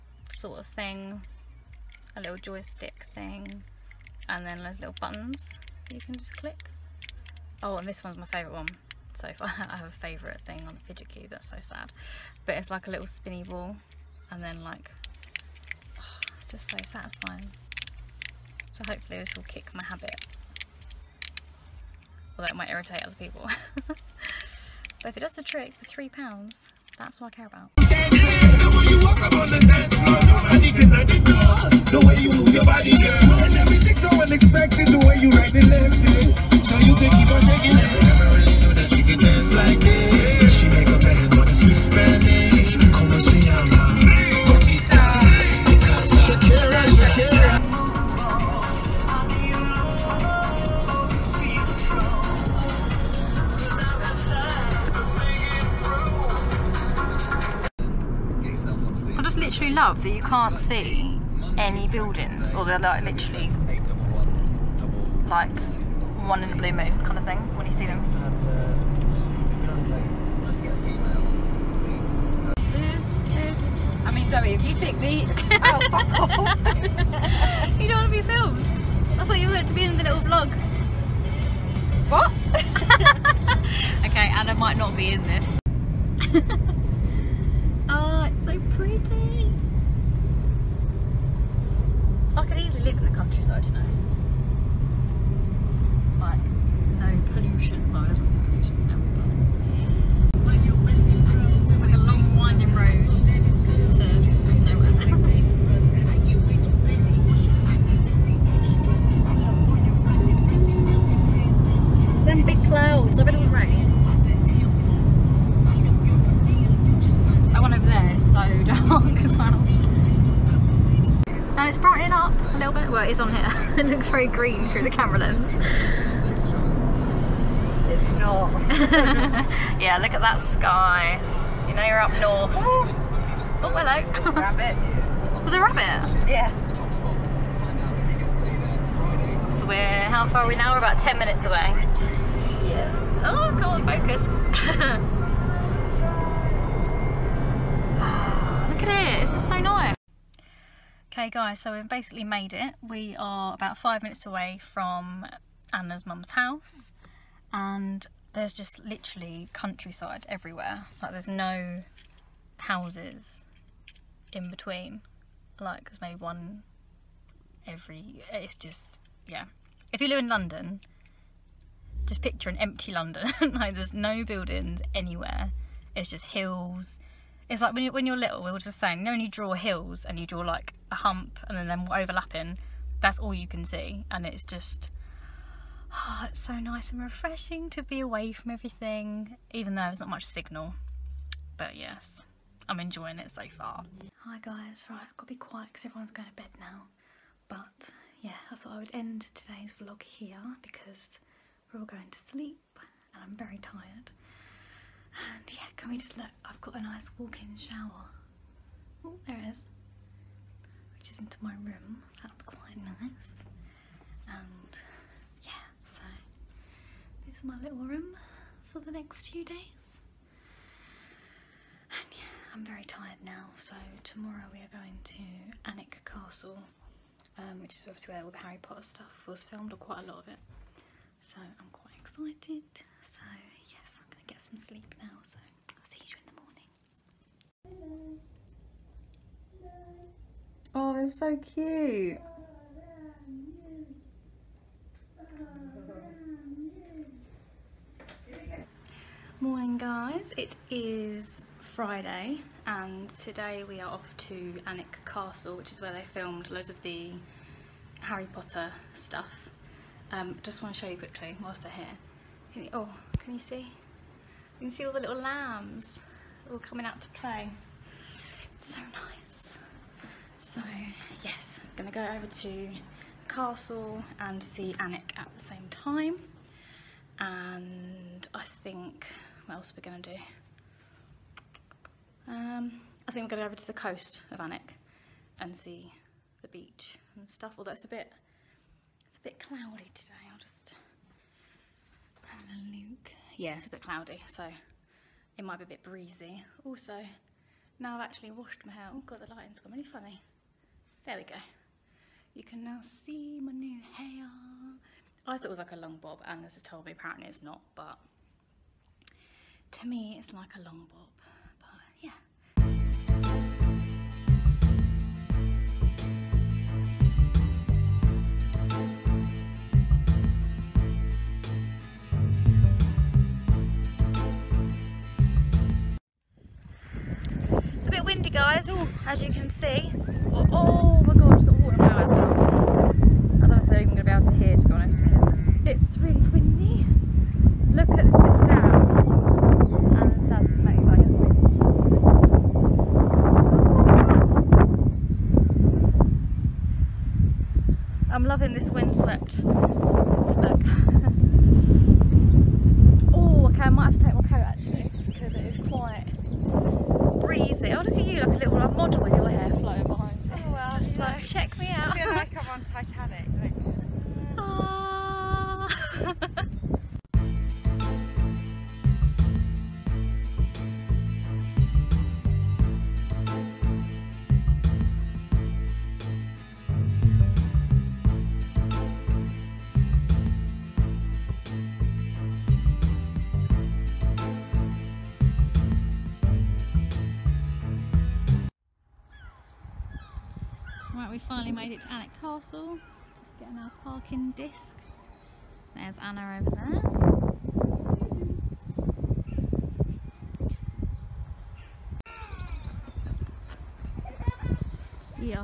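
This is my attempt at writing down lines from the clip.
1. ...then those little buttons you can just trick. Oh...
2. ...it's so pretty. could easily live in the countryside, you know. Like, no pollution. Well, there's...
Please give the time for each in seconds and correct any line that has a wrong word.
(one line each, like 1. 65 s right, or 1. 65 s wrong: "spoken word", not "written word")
1. 4 s wrong: "click", not "trick"
2. 88 s right.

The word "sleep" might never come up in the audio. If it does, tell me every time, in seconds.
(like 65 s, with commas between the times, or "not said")
202 s, 234 s.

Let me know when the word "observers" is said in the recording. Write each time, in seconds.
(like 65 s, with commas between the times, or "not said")
not said.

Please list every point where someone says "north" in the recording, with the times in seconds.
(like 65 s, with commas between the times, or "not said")
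132 s.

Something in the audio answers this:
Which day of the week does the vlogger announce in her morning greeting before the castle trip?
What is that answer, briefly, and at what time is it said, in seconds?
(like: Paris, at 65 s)
Friday, at 251 s.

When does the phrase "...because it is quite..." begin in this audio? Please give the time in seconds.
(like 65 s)
355 s.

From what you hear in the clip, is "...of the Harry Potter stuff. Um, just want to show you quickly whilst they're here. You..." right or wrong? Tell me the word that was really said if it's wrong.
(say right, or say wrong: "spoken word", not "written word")
right.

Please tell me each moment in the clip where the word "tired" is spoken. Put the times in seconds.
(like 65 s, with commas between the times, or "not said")
203 s, 222 s.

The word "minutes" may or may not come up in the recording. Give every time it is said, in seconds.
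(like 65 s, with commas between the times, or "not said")
141 s, 154 s.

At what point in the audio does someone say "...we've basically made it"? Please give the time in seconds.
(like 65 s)
151 s.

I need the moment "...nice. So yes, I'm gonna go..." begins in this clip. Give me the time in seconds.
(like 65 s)
268 s.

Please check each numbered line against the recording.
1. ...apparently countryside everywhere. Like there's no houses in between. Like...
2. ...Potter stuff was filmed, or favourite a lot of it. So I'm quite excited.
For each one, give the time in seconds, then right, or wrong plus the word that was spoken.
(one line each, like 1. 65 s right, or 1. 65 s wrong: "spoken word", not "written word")
1. 158 s wrong: "literally", not "apparently"
2. 228 s wrong: "quite", not "favourite".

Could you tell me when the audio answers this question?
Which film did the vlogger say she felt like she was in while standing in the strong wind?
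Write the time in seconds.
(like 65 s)
362 s.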